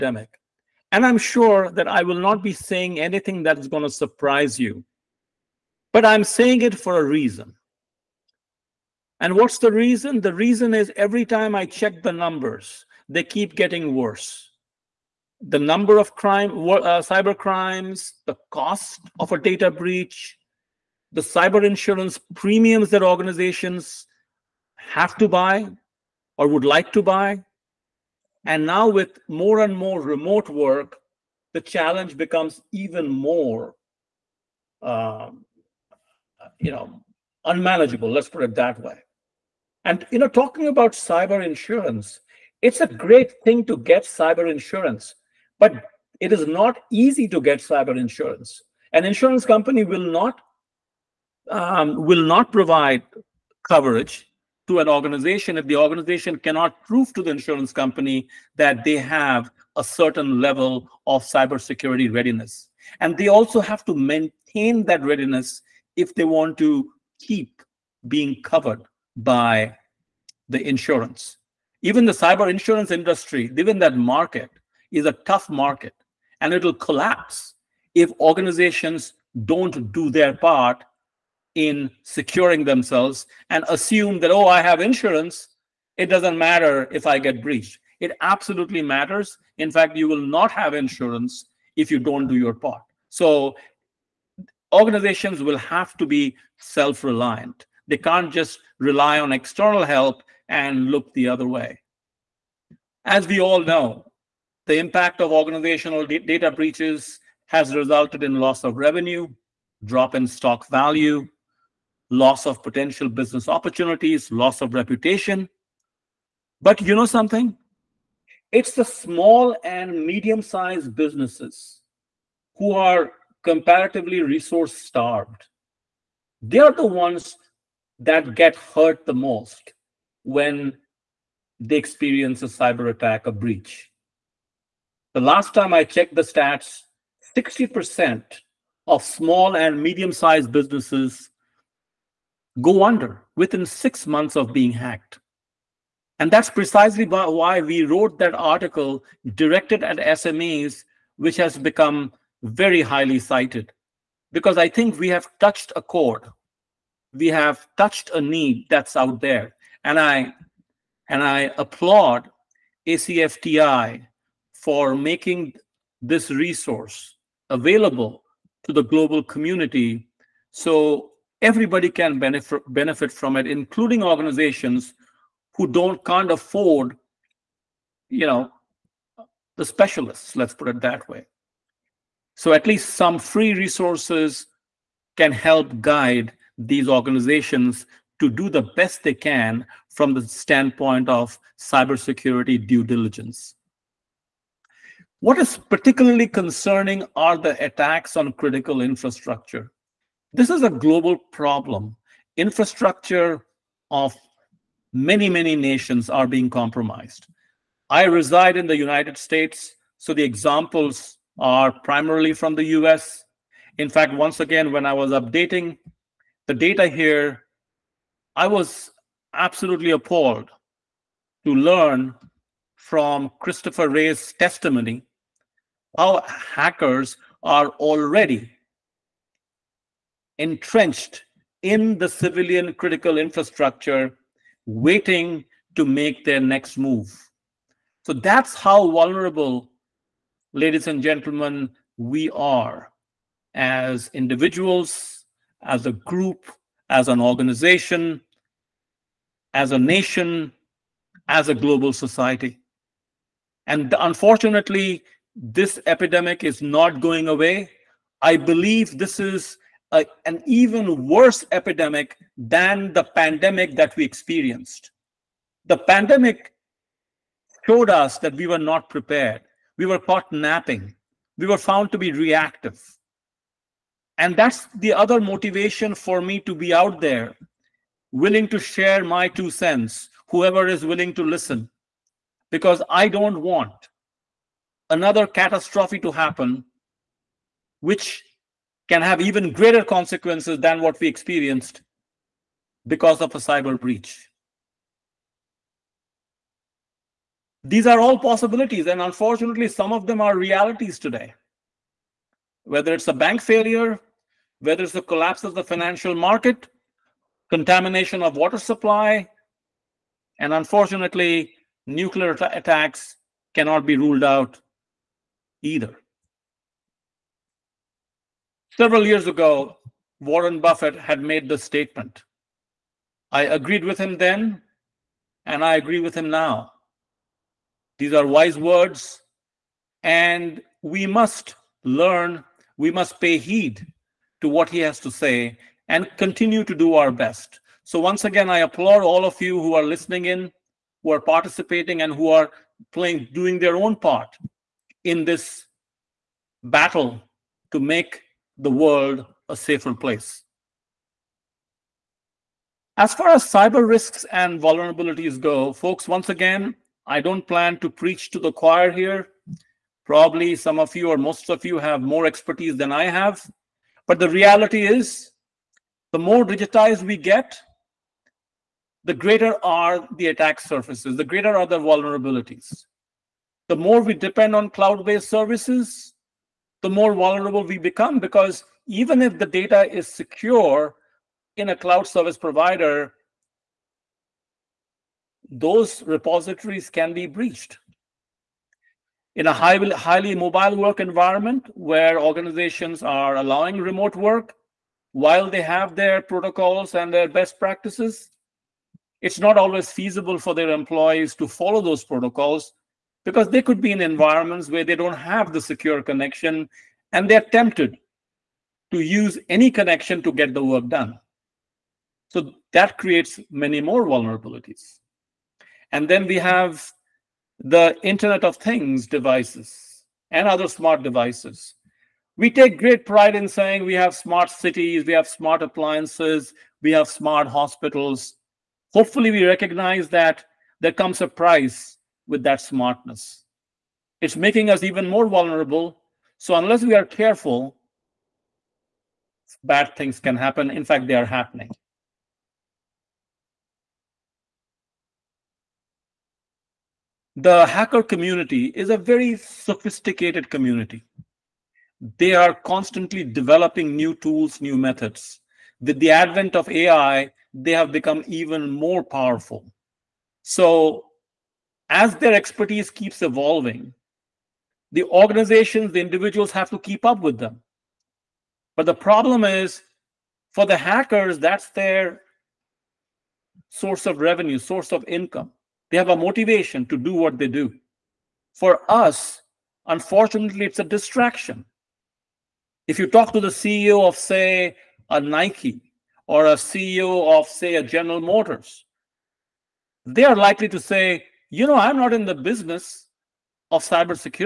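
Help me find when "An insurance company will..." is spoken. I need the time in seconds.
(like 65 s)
48 s.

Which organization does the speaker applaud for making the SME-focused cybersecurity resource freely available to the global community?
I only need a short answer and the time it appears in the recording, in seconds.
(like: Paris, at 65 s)
ACFTI, at 162 s.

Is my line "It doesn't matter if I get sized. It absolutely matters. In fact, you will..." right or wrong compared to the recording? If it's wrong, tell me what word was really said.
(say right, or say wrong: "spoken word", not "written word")
wrong: "breached", not "sized".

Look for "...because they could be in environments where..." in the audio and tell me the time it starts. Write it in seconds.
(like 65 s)
403 s.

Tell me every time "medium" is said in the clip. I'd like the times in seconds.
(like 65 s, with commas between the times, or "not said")
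120 s, 139 s.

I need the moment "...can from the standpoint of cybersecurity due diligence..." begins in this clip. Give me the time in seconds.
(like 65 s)
189 s.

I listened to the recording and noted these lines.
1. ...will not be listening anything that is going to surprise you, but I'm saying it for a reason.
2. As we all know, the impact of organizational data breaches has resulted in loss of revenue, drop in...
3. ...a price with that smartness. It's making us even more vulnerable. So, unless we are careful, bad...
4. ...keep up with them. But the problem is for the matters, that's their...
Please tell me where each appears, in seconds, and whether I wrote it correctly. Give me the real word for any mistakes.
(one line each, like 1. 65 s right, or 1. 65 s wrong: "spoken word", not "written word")
1. 2 s wrong: "saying", not "listening"
2. 103 s right
3. 431 s right
4. 466 s wrong: "hackers", not "matters".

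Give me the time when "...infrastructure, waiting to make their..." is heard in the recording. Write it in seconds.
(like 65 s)
233 s.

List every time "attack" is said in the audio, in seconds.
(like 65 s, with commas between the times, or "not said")
132 s, 197 s, 312 s, 370 s.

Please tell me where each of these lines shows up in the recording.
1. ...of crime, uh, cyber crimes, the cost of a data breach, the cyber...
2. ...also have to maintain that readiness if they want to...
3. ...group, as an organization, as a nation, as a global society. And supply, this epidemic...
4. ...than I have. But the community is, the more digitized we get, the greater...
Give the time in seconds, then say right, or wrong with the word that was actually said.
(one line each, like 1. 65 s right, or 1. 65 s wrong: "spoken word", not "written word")
1. 15 s right
2. 63 s right
3. 245 s wrong: "unfortunately", not "supply"
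4. 362 s wrong: "reality", not "community".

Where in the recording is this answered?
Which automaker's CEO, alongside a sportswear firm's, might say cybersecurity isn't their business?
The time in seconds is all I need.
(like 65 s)
487 s.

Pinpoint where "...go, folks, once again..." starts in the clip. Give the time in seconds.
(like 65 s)
355 s.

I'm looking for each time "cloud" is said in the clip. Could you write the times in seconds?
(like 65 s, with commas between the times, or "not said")
374 s, 381 s.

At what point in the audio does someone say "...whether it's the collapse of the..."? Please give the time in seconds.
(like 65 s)
304 s.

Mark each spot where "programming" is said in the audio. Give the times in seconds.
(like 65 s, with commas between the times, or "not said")
not said.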